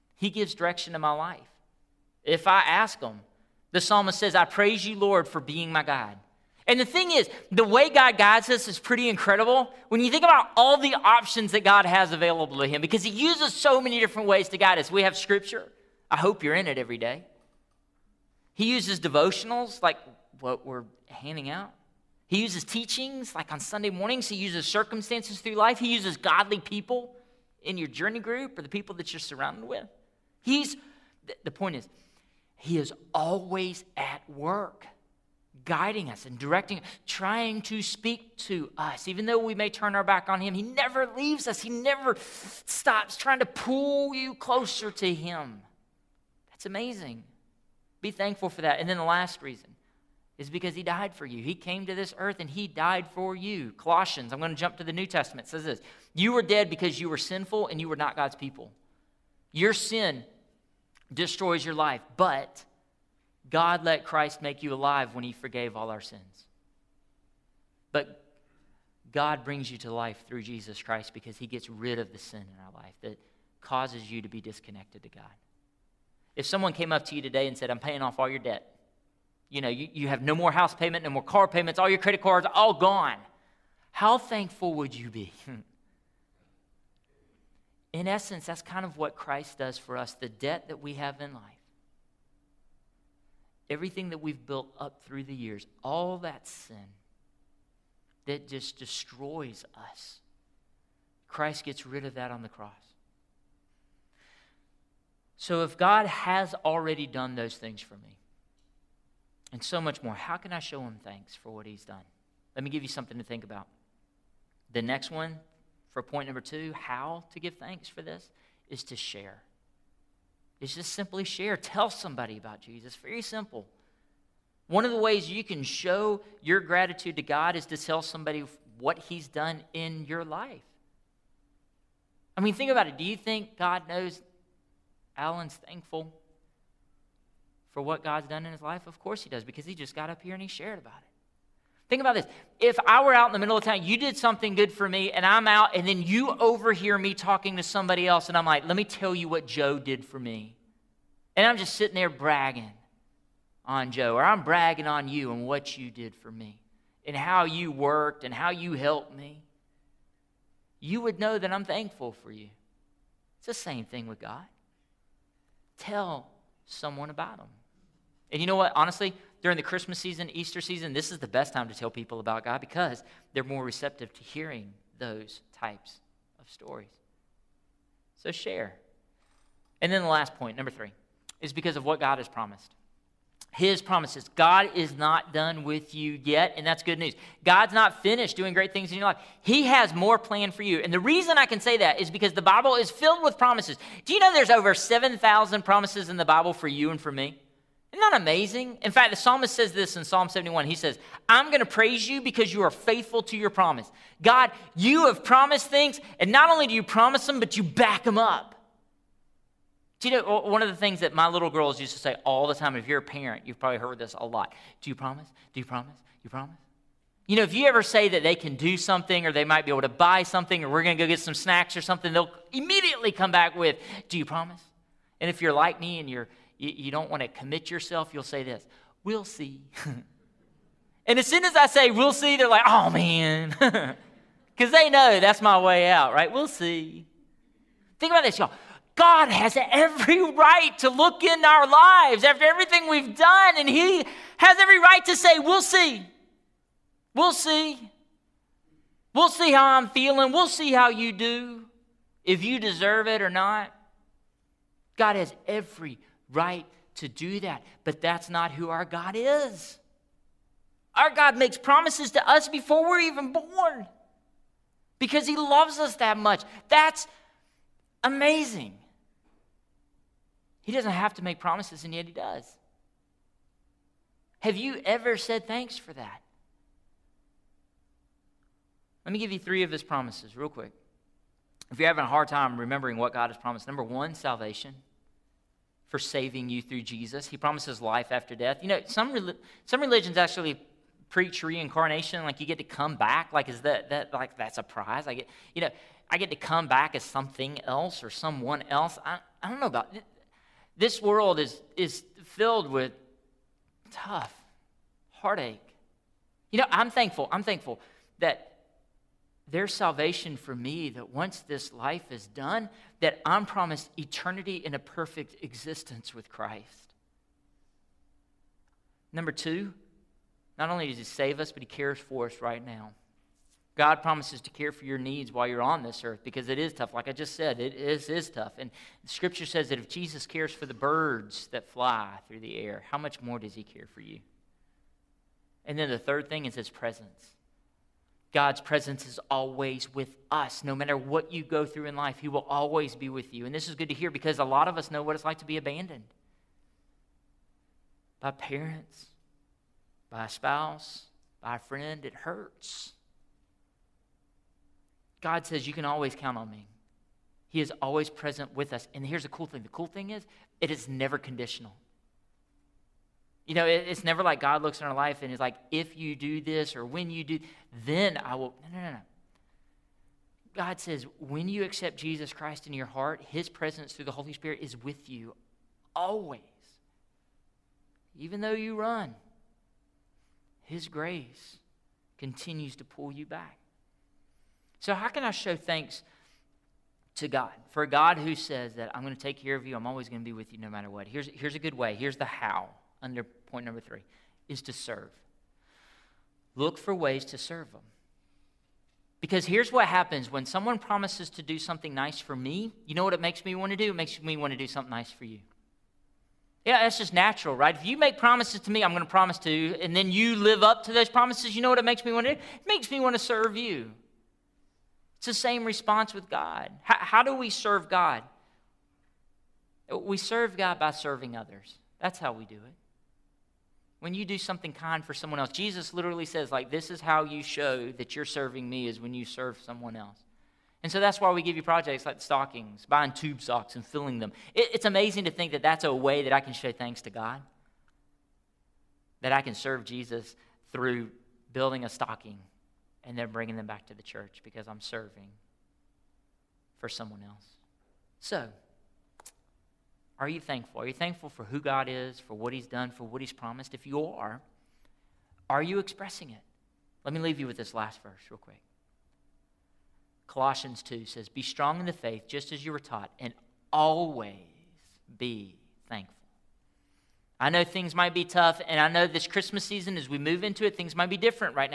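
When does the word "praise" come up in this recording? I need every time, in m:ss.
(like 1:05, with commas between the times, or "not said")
0:04, 3:21.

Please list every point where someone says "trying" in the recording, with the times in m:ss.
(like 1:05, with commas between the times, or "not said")
0:37, 0:43.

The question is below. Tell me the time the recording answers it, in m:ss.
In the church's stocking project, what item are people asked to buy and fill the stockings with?
7:13.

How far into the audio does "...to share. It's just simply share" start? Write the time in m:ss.
1:58.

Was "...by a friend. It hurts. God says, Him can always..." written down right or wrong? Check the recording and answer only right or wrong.
wrong.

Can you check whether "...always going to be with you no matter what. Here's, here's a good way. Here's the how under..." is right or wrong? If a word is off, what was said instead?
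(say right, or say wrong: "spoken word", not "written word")
right.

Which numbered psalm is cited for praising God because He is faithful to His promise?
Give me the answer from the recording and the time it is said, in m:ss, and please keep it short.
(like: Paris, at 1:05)
Psalm 71, at 3:20.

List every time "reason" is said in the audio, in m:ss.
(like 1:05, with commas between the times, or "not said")
0:49, 3:10.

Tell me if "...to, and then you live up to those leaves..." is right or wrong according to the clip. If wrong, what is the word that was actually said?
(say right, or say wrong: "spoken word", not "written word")
wrong: "promises", not "leaves".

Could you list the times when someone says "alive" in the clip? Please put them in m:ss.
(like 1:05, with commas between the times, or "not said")
1:04.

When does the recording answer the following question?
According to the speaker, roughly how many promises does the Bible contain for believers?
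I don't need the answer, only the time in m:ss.
3:14.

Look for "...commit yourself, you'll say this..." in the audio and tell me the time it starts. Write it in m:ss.
3:47.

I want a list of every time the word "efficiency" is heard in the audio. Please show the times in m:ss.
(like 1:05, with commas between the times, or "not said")
not said.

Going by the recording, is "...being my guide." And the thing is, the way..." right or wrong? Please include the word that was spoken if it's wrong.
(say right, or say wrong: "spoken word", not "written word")
right.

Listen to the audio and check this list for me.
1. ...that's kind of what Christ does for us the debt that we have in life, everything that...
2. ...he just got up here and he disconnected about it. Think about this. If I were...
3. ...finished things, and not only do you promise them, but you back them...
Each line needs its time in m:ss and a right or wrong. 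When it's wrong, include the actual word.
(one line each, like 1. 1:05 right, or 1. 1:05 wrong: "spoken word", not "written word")
1. 1:28 right
2. 2:19 wrong: "shared", not "disconnected"
3. 3:25 wrong: "promised", not "finished".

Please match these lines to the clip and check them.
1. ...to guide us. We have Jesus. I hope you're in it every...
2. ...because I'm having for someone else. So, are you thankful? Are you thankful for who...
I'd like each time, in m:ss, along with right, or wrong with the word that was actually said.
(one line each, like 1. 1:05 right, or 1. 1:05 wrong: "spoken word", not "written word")
1. 0:14 wrong: "Scripture", not "Jesus"
2. 7:24 wrong: "serving", not "having".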